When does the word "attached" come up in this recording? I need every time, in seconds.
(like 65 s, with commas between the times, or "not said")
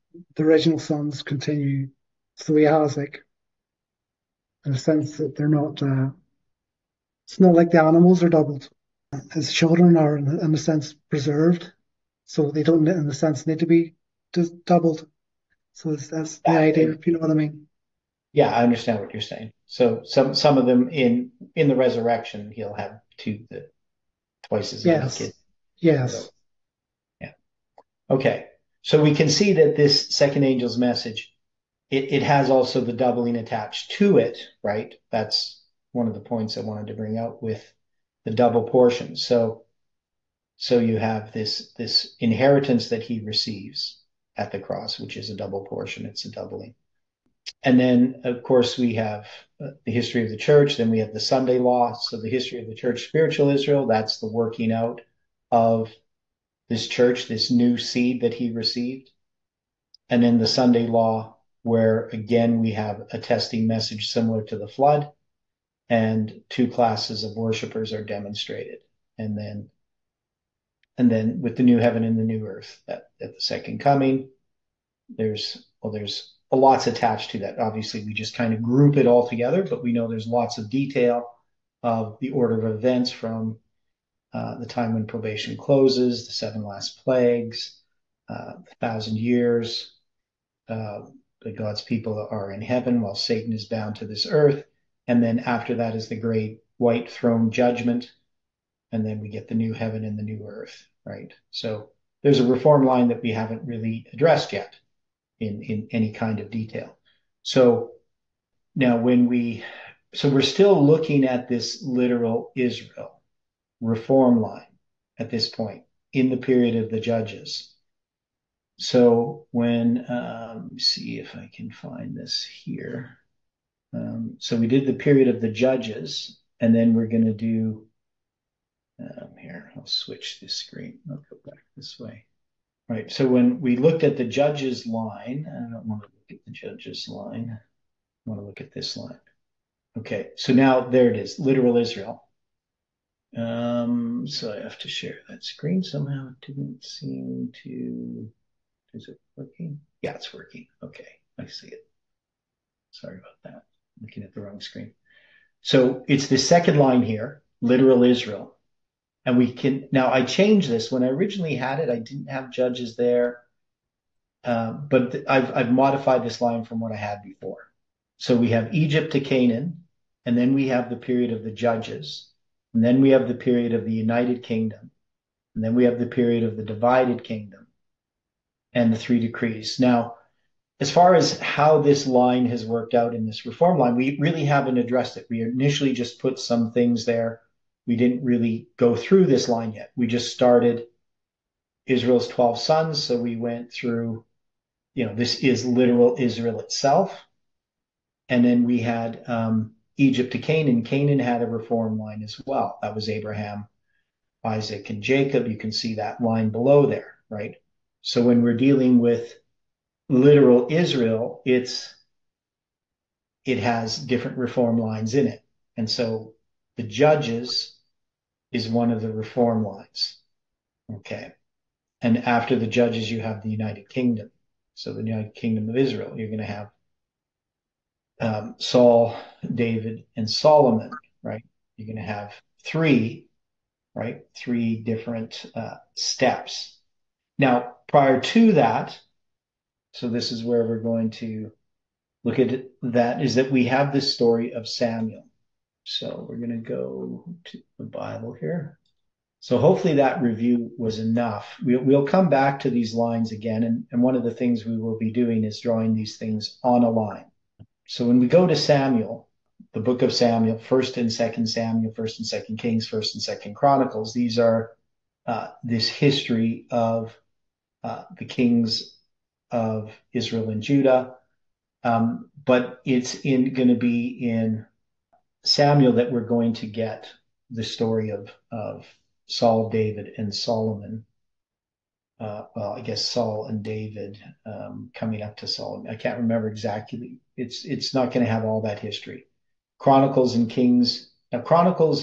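33 s, 76 s.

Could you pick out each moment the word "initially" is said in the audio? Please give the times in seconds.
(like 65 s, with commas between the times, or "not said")
185 s.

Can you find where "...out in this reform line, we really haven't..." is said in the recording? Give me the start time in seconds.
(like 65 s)
182 s.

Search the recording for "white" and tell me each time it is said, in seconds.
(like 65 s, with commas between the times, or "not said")
96 s.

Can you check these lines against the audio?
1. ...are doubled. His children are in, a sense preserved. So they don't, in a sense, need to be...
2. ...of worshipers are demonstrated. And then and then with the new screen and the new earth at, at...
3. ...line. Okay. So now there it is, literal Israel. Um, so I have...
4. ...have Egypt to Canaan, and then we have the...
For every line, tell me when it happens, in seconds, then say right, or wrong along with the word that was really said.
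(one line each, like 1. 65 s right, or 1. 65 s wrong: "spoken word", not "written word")
1. 8 s right
2. 67 s wrong: "heaven", not "screen"
3. 138 s right
4. 168 s right.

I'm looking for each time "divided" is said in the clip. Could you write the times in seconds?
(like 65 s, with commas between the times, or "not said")
176 s.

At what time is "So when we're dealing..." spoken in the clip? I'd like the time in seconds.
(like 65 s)
208 s.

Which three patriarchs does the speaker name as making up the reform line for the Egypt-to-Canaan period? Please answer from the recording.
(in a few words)
Abraham, Isaac, and Jacob.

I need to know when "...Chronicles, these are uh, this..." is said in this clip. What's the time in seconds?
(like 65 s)
263 s.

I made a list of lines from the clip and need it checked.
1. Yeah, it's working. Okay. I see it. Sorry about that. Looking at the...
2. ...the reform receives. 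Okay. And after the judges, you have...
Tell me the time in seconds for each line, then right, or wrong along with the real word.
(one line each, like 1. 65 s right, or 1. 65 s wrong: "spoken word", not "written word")
1. 150 s right
2. 219 s wrong: "lines", not "receives".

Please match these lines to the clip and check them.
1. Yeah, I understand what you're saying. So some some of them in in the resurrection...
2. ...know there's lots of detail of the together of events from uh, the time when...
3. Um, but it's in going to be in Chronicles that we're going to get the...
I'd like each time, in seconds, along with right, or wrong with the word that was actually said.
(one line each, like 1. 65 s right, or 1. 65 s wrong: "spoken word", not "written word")
1. 18 s right
2. 79 s wrong: "order", not "together"
3. 271 s wrong: "Samuel", not "Chronicles".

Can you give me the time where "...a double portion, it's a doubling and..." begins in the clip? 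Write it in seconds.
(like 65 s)
45 s.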